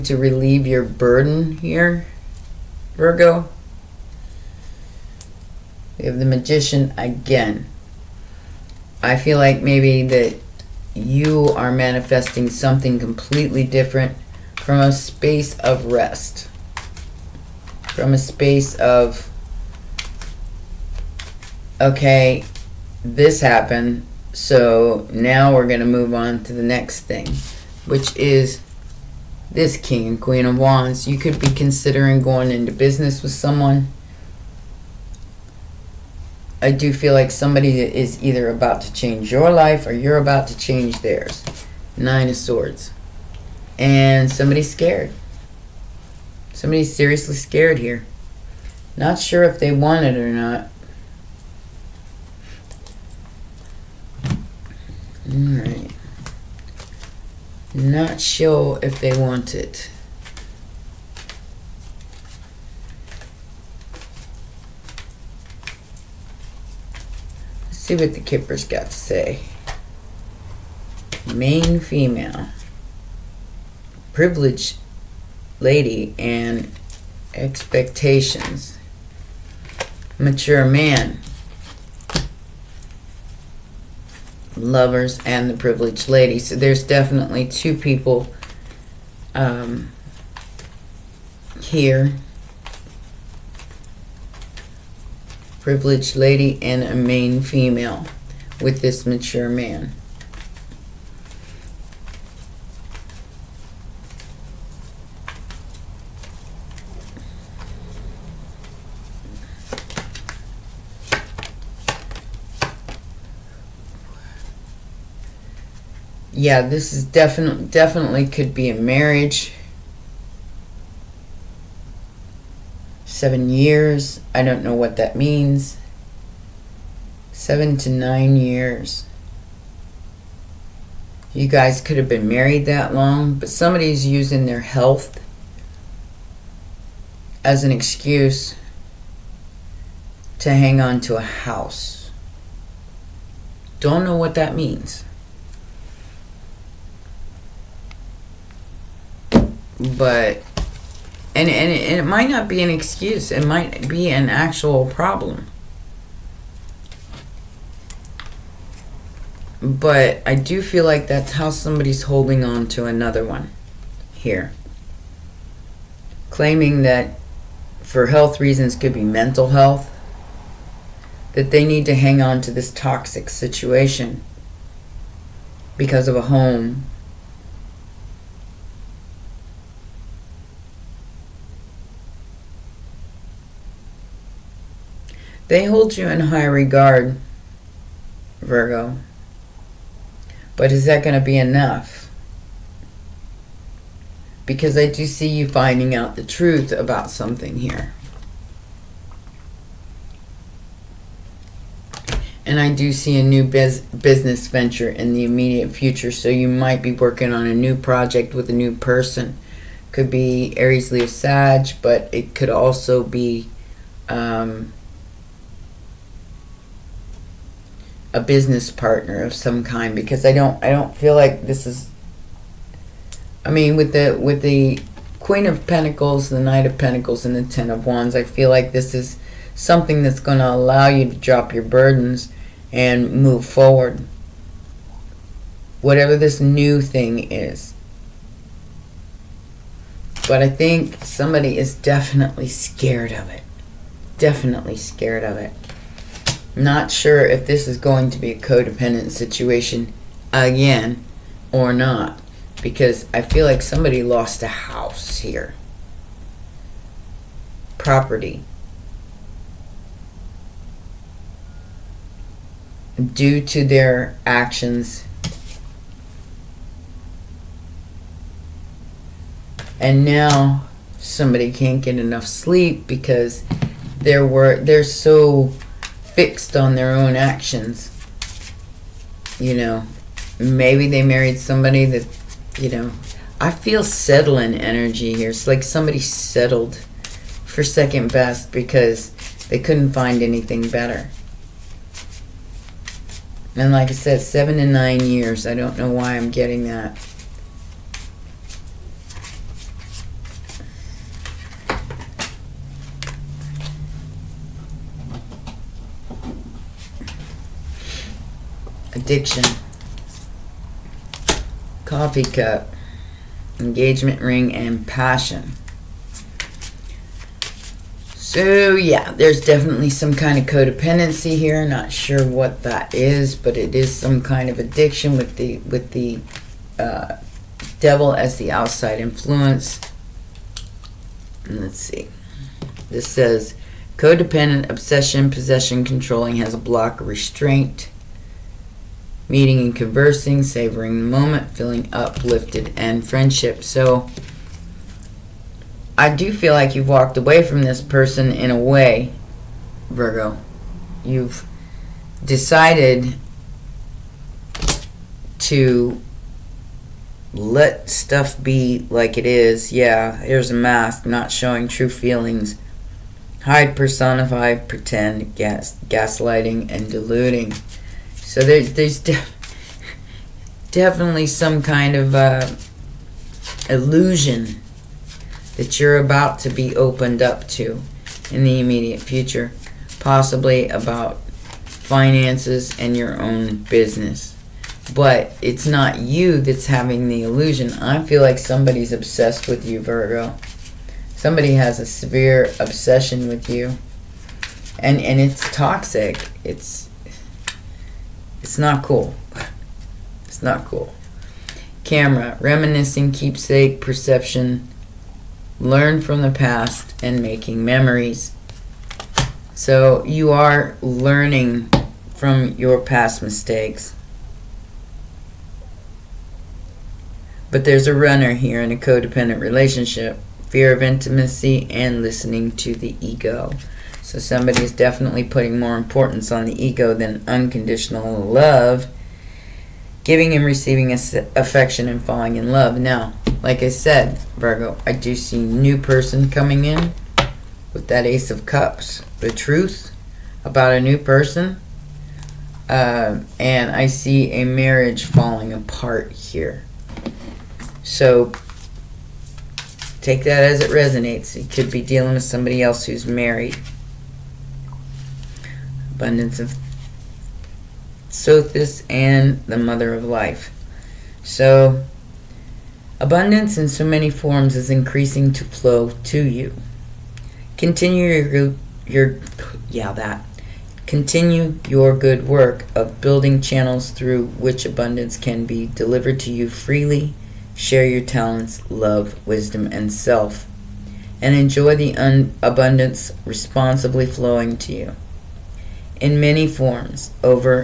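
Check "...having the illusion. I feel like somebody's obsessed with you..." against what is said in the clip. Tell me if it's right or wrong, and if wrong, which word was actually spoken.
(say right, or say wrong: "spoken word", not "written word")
right.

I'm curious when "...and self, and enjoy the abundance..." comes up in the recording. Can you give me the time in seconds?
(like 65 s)
479 s.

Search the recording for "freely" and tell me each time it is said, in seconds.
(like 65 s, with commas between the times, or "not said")
476 s.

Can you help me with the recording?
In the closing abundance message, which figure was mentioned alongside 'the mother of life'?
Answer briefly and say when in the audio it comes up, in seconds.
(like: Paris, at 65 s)
Sothis, at 458 s.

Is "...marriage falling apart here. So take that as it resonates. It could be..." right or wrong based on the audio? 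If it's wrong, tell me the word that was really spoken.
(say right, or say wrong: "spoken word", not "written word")
right.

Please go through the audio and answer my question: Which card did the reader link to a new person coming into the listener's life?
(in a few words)
Ace of Cups.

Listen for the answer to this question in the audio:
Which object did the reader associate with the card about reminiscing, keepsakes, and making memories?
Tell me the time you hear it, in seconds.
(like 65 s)
401 s.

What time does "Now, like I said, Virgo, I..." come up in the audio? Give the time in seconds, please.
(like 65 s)
432 s.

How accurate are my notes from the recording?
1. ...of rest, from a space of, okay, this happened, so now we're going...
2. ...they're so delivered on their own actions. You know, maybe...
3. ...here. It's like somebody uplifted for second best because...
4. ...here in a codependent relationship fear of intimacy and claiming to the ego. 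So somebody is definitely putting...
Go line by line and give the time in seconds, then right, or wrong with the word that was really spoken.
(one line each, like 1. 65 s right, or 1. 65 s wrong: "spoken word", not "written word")
1. 15 s right
2. 274 s wrong: "fixed", not "delivered"
3. 285 s wrong: "settled", not "uplifted"
4. 418 s wrong: "listening", not "claiming".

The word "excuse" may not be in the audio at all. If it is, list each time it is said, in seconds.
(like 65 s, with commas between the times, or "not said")
137 s, 152 s.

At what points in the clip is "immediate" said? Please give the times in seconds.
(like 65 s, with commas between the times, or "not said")
205 s, 378 s.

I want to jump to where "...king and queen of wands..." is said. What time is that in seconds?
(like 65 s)
29 s.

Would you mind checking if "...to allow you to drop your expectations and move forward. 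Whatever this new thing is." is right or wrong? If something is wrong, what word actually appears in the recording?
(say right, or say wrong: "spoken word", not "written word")
wrong: "burdens", not "expectations".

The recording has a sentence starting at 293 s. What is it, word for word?
And like I said, seven to nine years.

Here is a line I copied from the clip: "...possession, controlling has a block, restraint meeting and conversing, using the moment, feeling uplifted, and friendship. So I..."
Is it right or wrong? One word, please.
wrong.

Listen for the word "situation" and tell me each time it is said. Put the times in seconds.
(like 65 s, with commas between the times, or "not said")
173 s, 249 s.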